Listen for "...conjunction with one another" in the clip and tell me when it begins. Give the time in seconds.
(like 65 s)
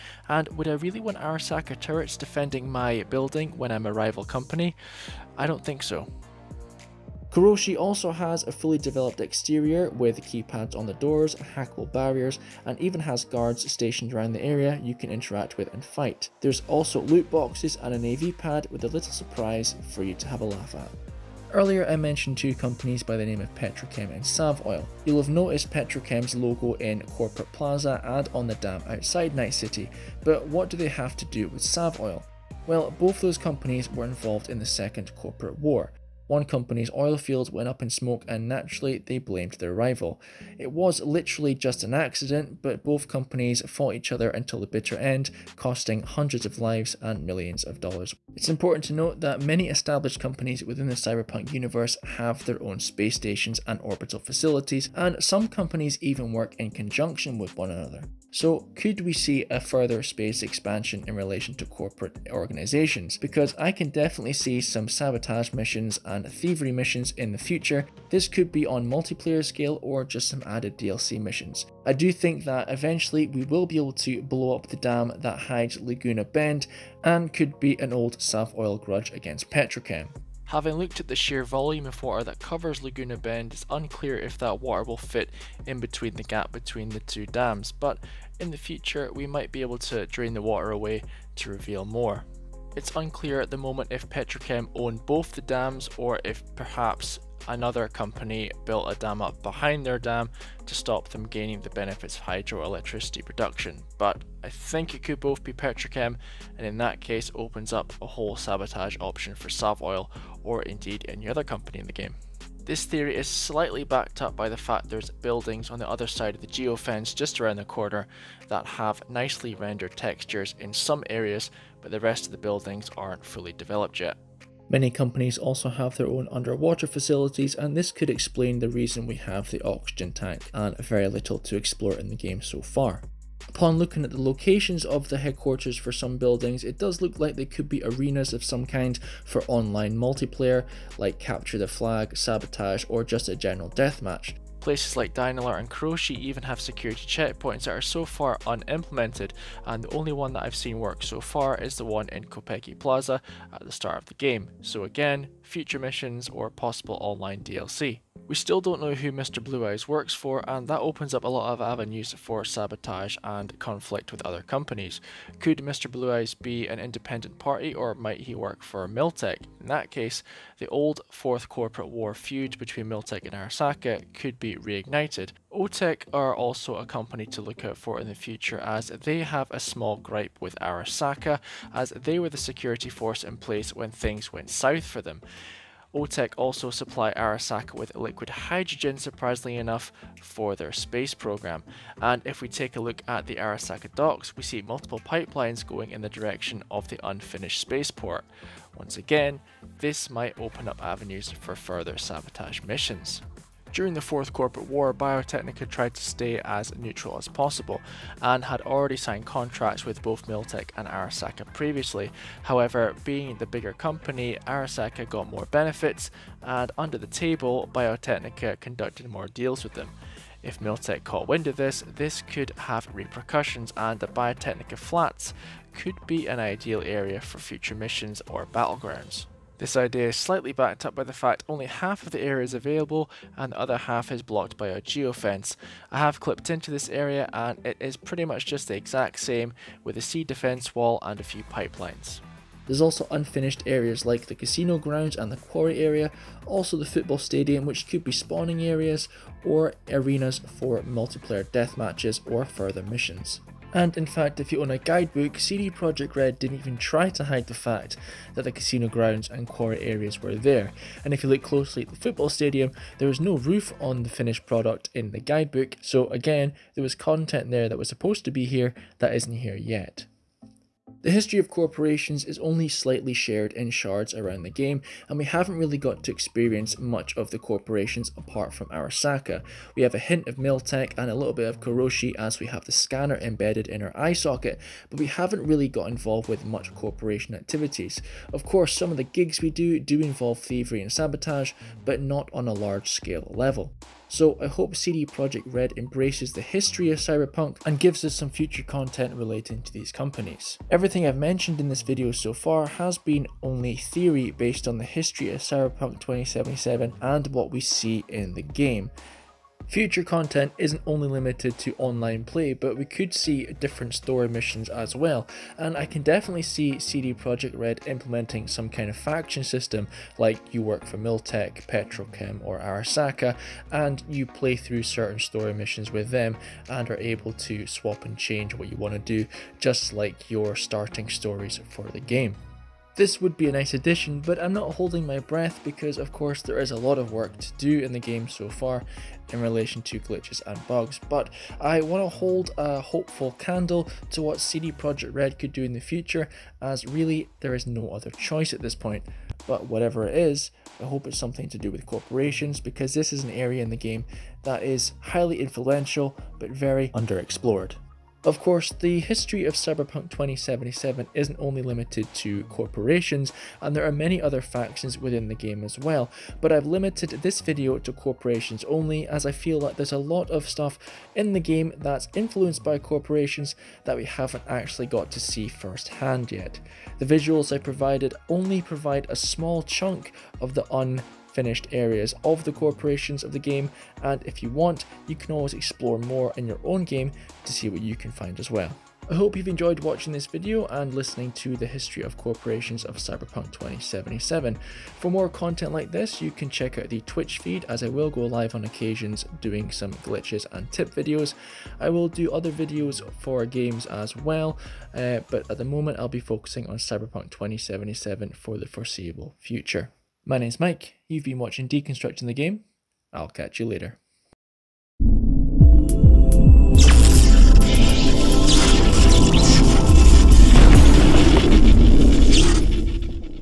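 56 s.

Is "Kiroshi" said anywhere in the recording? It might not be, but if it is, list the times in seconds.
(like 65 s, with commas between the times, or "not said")
7 s, 145 s, 281 s.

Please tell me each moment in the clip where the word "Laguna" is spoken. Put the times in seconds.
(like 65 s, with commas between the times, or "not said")
75 s, 82 s.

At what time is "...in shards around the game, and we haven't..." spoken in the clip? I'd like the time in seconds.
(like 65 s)
273 s.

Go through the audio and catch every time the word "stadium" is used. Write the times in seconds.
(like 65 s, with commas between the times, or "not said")
247 s, 262 s.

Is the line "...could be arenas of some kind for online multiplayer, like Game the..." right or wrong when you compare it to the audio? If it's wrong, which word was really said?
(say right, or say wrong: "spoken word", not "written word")
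wrong: "Capture", not "Game".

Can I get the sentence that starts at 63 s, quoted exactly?
Because I can definitely see some sabotage missions and thievery missions in the future.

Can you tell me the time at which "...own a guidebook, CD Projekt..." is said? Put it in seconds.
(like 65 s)
254 s.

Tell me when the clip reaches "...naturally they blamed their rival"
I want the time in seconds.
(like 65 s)
38 s.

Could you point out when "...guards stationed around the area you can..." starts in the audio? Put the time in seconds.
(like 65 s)
13 s.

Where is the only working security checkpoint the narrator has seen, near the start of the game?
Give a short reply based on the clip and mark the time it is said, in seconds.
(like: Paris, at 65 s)
Konpeki Plaza, at 152 s.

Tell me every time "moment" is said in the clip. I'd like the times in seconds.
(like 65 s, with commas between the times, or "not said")
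93 s, 405 s.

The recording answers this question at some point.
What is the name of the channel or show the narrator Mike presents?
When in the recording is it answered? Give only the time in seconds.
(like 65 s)
411 s.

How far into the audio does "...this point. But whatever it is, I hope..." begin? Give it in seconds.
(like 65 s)
348 s.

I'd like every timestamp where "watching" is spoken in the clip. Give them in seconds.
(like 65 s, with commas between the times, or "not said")
389 s, 411 s.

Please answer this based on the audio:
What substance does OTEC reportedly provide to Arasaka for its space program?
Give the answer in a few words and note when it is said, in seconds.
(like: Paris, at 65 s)
liquid hydrogen, at 187 s.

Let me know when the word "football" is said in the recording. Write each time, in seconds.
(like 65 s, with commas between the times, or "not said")
246 s, 261 s.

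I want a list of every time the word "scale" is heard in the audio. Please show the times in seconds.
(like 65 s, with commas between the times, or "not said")
69 s, 292 s.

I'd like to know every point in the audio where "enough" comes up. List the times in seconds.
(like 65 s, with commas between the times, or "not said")
189 s.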